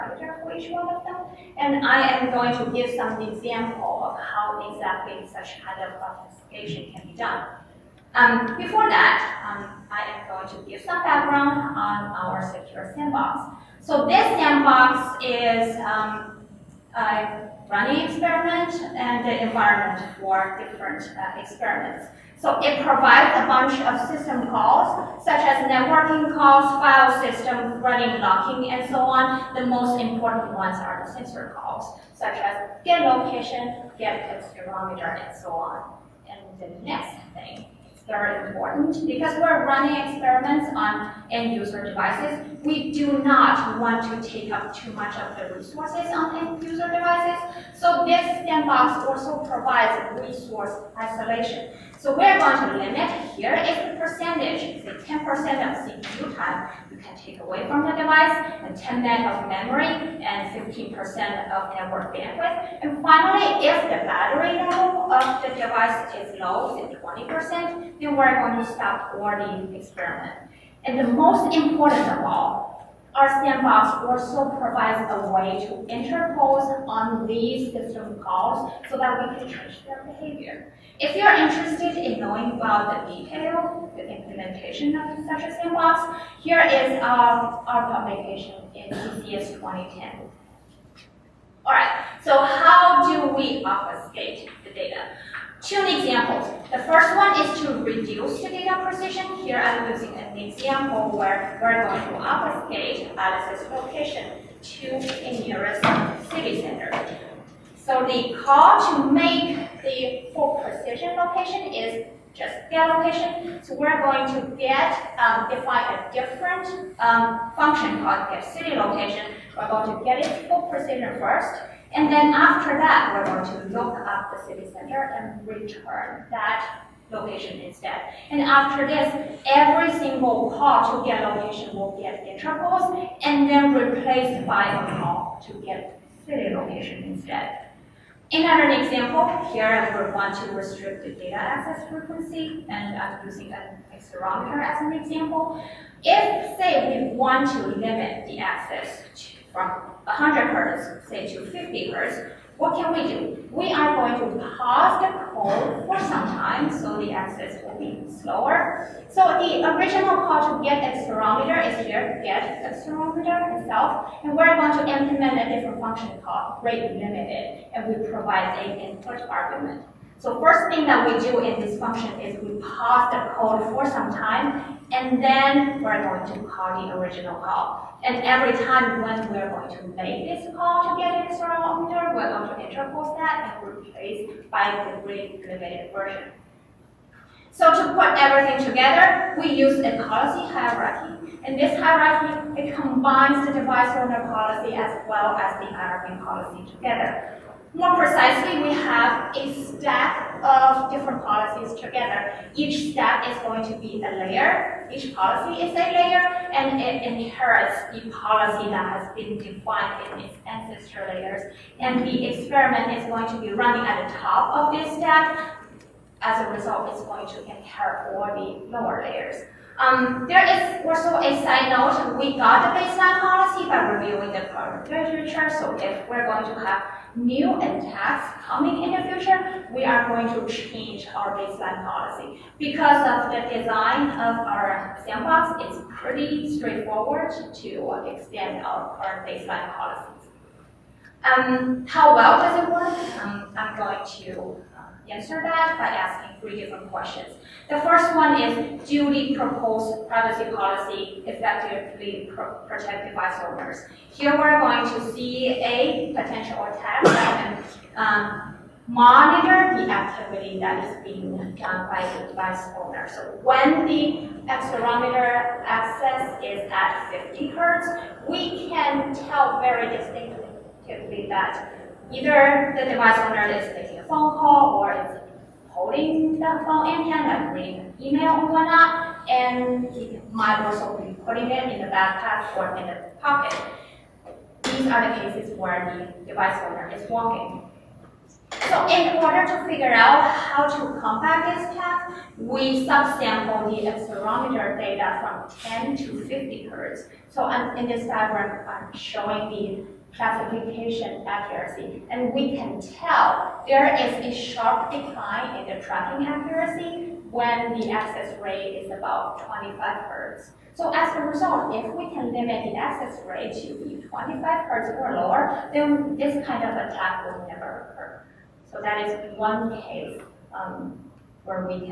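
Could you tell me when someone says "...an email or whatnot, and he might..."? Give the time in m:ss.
4:37.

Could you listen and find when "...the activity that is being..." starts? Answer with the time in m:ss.
4:19.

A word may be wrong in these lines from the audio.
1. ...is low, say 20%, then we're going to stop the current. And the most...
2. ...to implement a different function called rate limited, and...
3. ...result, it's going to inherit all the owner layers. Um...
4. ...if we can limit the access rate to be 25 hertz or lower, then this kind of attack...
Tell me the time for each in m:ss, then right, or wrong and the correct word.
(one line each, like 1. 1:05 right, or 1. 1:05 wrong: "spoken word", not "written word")
1. 1:06 wrong: "experiment", not "current"
2. 2:44 right
3. 3:36 wrong: "lower", not "owner"
4. 5:11 right.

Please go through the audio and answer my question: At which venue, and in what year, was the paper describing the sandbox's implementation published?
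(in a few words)
CCS 2010.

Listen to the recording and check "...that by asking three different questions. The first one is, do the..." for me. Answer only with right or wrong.
right.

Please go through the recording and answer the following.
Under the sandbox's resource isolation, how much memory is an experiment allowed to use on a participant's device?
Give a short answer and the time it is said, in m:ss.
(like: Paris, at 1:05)
10 MB, at 0:58.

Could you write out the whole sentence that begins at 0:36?
And the next thing very important because we're running experiments on end user devices.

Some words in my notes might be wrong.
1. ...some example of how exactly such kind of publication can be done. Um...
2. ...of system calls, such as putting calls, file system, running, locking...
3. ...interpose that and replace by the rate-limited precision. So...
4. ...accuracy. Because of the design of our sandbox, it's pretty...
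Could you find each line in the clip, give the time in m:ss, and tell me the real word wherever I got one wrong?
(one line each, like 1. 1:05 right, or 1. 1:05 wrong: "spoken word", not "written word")
1. 0:02 wrong: "authentication", not "publication"
2. 0:23 wrong: "networking", not "putting"
3. 3:02 wrong: "version", not "precision"
4. 3:51 wrong: "policy", not "accuracy".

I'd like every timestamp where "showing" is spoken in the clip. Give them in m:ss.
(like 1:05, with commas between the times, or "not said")
4:58.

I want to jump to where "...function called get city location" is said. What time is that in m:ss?
1:57.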